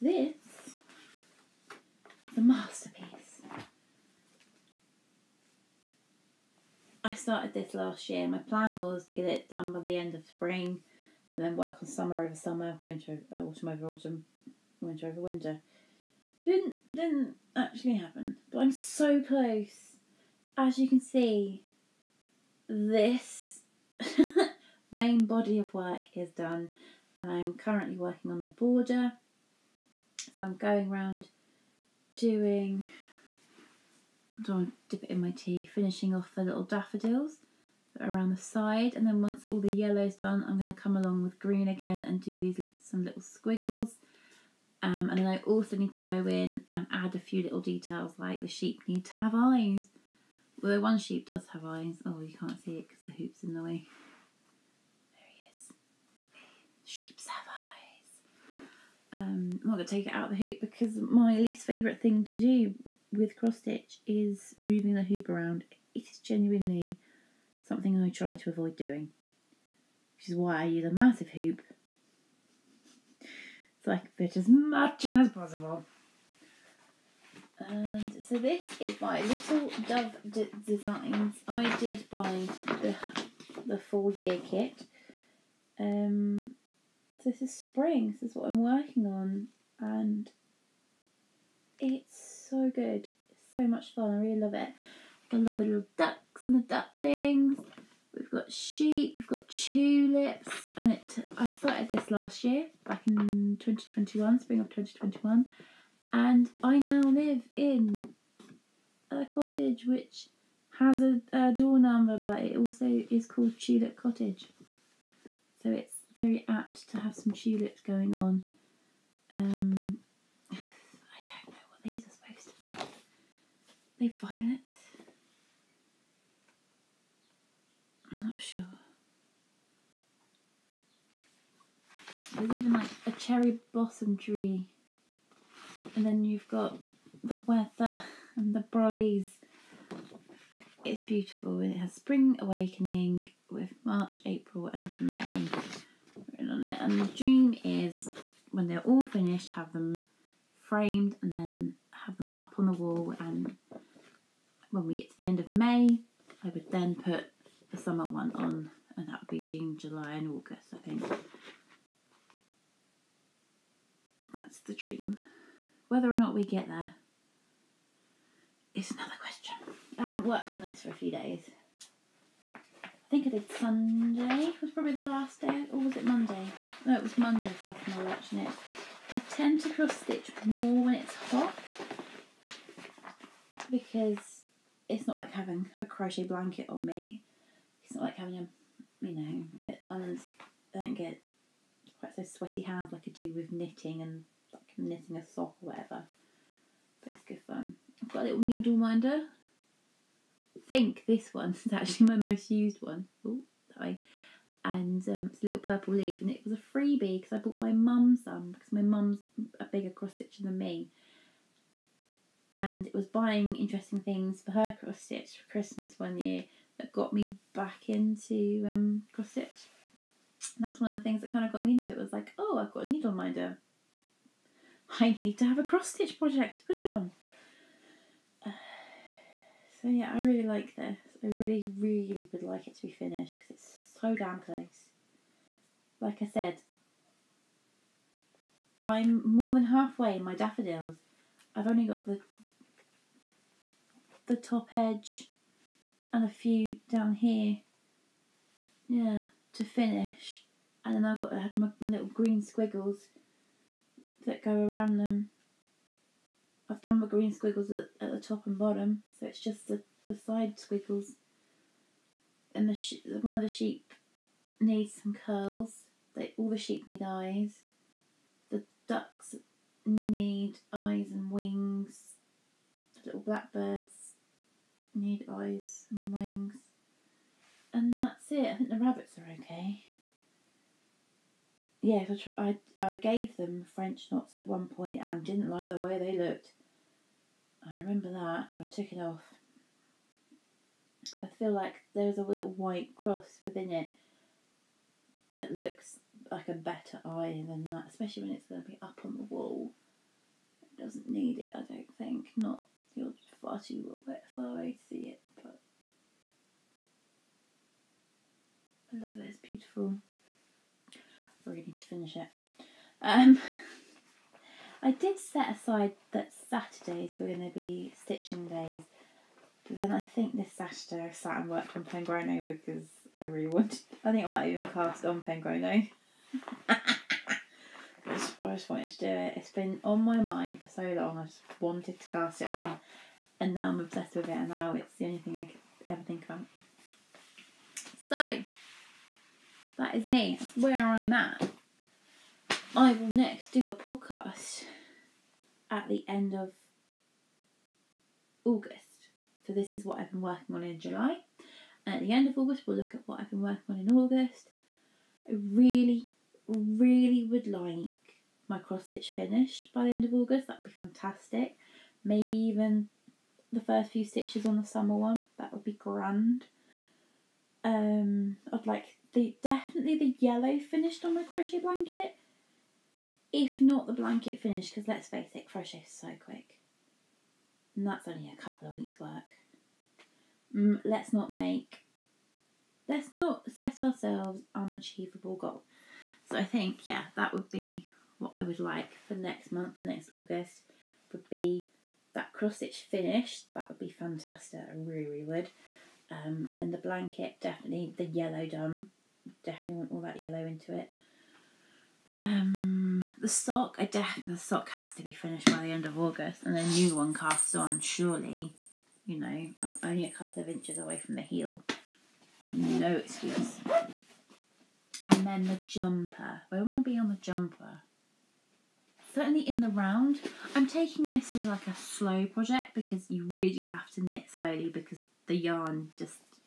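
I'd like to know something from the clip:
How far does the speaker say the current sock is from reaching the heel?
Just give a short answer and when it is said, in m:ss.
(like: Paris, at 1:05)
A couple of inches, at 6:50.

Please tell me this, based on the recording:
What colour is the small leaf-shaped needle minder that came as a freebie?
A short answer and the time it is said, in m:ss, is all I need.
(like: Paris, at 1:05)
Purple, at 3:25.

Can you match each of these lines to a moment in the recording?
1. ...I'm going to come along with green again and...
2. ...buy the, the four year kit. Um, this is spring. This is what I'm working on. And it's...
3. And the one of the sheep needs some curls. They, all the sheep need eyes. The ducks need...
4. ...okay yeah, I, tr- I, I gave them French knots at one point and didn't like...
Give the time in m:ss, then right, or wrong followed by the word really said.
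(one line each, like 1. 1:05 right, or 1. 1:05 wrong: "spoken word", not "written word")
1. 0:40 right
2. 1:22 right
3. 4:22 right
4. 4:39 right.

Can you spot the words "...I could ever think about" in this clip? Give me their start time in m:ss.
5:35.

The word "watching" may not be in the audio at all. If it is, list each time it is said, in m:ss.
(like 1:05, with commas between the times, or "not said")
2:58.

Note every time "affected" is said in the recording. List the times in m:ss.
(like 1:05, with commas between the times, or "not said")
not said.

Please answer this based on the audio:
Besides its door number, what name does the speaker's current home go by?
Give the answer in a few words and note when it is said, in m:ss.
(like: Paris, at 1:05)
Tulip Cottage, at 1:53.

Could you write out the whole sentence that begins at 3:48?
Uh, so yeah, I really like this.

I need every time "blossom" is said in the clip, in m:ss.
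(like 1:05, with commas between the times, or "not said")
2:13.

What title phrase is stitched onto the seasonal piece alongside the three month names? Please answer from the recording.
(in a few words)
Spring Awakening.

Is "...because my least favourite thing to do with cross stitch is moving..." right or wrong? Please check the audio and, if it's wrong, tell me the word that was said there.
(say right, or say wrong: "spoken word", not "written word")
right.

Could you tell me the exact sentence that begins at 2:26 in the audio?
And the dream is when they're all finished, have them framed and then have them up on the wall.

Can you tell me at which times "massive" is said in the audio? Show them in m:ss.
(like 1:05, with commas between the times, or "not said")
1:10.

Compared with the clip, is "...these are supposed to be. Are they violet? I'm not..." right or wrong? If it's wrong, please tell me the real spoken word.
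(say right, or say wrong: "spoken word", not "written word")
right.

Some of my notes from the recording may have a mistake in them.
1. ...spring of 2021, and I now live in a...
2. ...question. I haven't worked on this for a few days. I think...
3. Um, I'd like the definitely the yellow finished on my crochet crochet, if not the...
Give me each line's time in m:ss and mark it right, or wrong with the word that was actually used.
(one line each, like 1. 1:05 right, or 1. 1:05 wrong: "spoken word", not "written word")
1. 1:44 right
2. 2:49 right
3. 6:07 wrong: "blanket", not "crochet".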